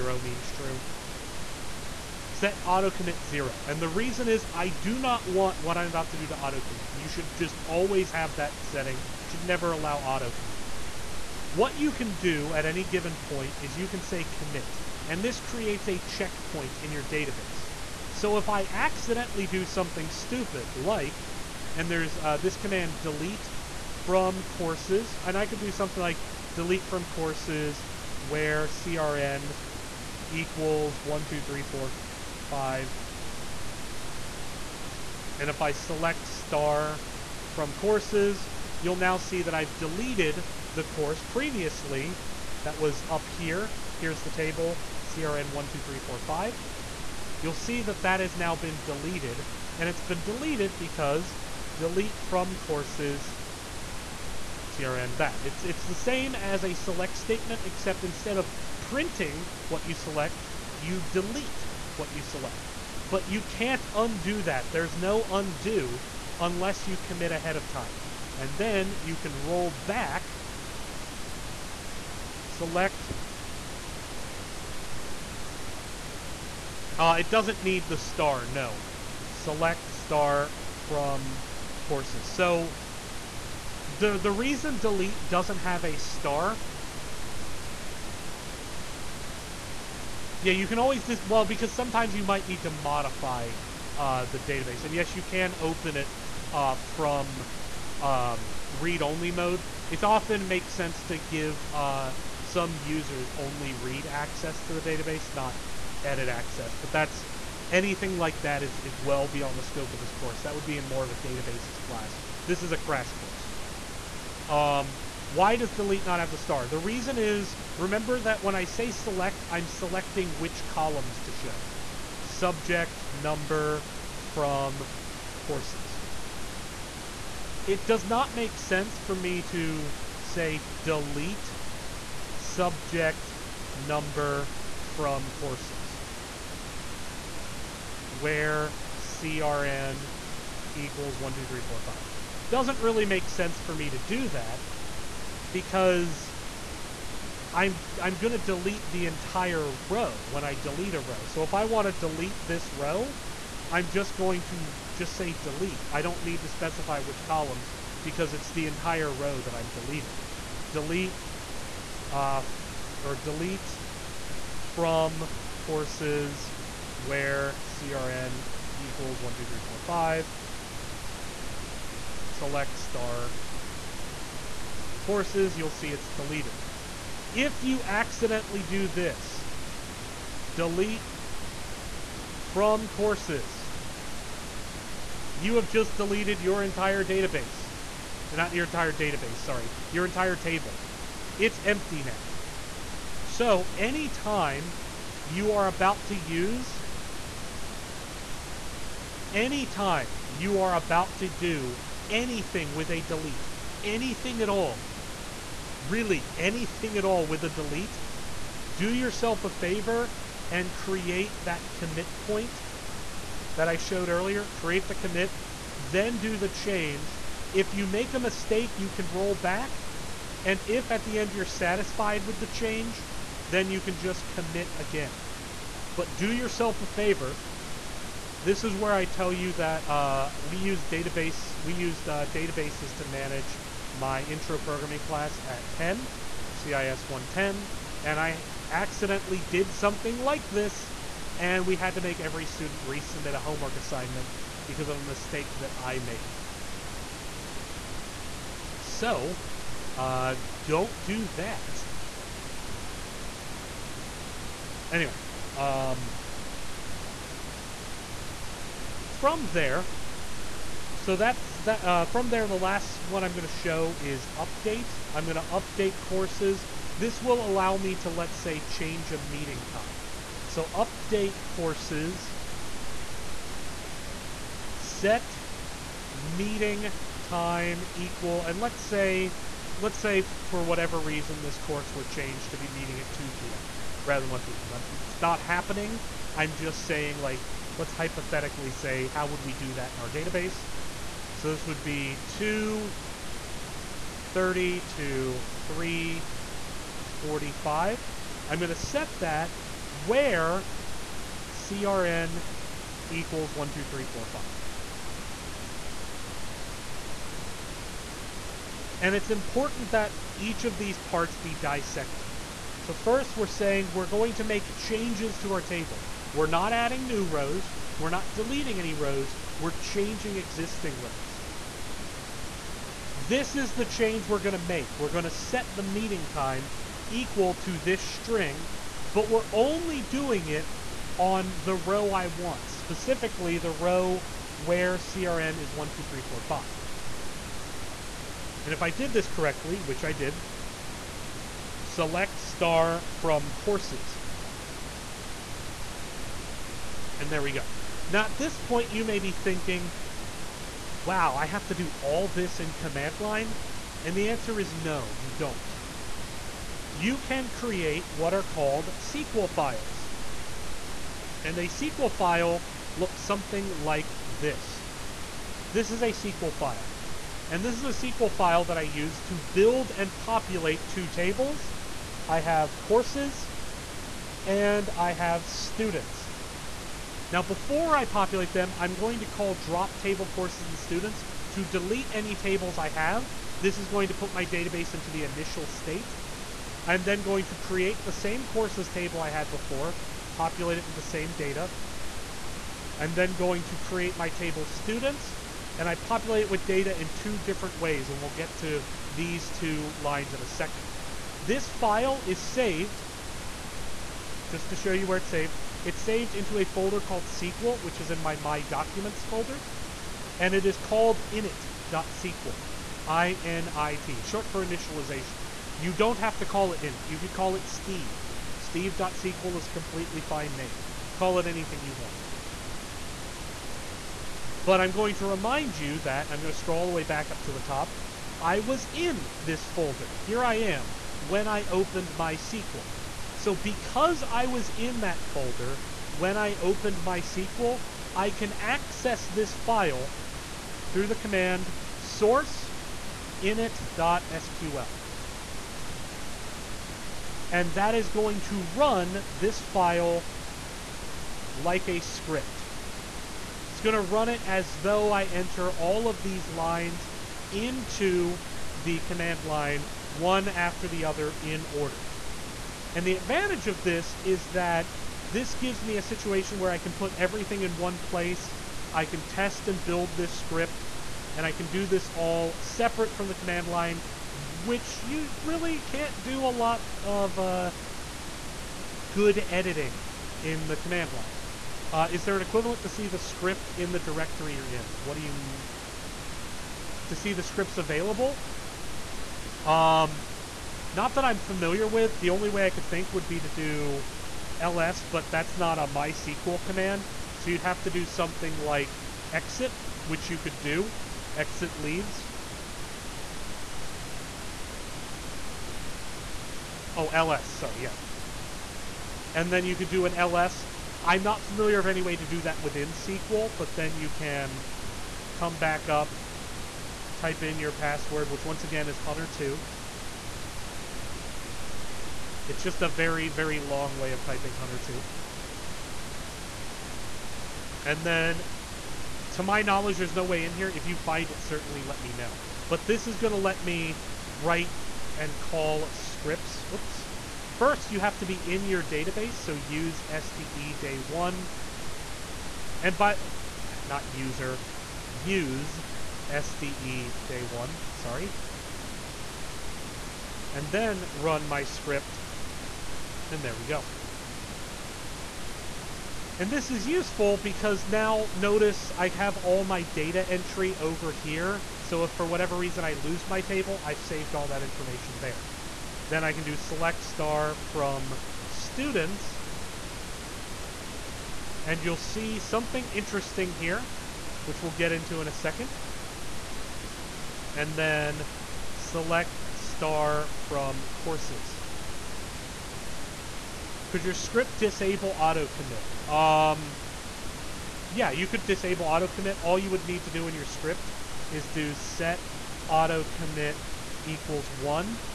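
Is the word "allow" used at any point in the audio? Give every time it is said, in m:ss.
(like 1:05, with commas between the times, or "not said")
0:09, 4:27.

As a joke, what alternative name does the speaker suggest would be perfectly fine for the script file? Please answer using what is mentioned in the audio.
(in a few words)
Steve.sql.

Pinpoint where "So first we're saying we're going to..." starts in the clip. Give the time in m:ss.
5:12.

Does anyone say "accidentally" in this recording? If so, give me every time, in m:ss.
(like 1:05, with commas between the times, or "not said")
0:18, 2:57, 3:58.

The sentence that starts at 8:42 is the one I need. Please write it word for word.
It's just a very, very long way of typing Hunter2.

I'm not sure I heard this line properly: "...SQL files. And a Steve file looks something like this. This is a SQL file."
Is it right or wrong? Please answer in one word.
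wrong.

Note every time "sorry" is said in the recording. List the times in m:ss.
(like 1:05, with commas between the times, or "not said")
3:09, 8:27, 9:07.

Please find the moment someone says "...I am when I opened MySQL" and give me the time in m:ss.
7:10.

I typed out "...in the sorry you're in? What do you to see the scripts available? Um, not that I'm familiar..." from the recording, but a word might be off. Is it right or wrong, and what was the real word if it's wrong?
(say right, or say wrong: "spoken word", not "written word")
wrong: "directory", not "sorry".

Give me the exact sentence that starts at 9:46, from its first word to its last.
Um, yeah, you could disable auto commit.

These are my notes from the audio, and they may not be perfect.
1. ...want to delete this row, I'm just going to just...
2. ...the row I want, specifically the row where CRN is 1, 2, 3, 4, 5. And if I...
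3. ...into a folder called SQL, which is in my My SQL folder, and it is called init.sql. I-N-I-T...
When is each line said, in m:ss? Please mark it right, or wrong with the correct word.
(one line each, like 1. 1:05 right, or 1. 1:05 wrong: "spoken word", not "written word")
1. 2:31 right
2. 5:31 right
3. 6:46 wrong: "Documents", not "SQL".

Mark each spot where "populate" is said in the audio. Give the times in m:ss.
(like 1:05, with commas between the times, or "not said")
6:10, 6:18, 6:30, 6:35.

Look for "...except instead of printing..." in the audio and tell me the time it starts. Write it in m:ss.
0:57.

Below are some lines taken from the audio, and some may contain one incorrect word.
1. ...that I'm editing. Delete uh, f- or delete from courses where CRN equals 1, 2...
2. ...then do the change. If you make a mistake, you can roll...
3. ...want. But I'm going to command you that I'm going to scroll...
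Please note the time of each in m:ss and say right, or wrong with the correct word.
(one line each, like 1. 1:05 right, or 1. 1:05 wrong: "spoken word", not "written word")
1. 2:39 wrong: "deleting", not "editing"
2. 3:35 right
3. 7:01 wrong: "remind", not "command".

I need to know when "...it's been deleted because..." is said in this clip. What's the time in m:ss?
0:49.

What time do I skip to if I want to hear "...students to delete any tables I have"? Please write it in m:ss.
6:20.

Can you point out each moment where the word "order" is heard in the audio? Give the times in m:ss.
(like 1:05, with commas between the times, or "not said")
7:41.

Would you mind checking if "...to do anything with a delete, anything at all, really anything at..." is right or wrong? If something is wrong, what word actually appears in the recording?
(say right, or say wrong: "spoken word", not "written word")
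right.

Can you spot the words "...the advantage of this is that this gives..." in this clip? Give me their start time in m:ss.
7:43.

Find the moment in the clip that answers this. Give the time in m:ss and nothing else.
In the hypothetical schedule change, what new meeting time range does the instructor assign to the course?
4:52.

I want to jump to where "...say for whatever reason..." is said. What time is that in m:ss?
4:39.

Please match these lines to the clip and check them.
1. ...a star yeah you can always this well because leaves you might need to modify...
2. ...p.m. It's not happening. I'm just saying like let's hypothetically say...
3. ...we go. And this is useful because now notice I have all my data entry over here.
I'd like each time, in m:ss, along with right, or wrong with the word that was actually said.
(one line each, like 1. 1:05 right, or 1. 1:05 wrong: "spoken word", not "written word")
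1. 1:25 wrong: "sometimes", not "leaves"
2. 4:44 right
3. 9:13 right.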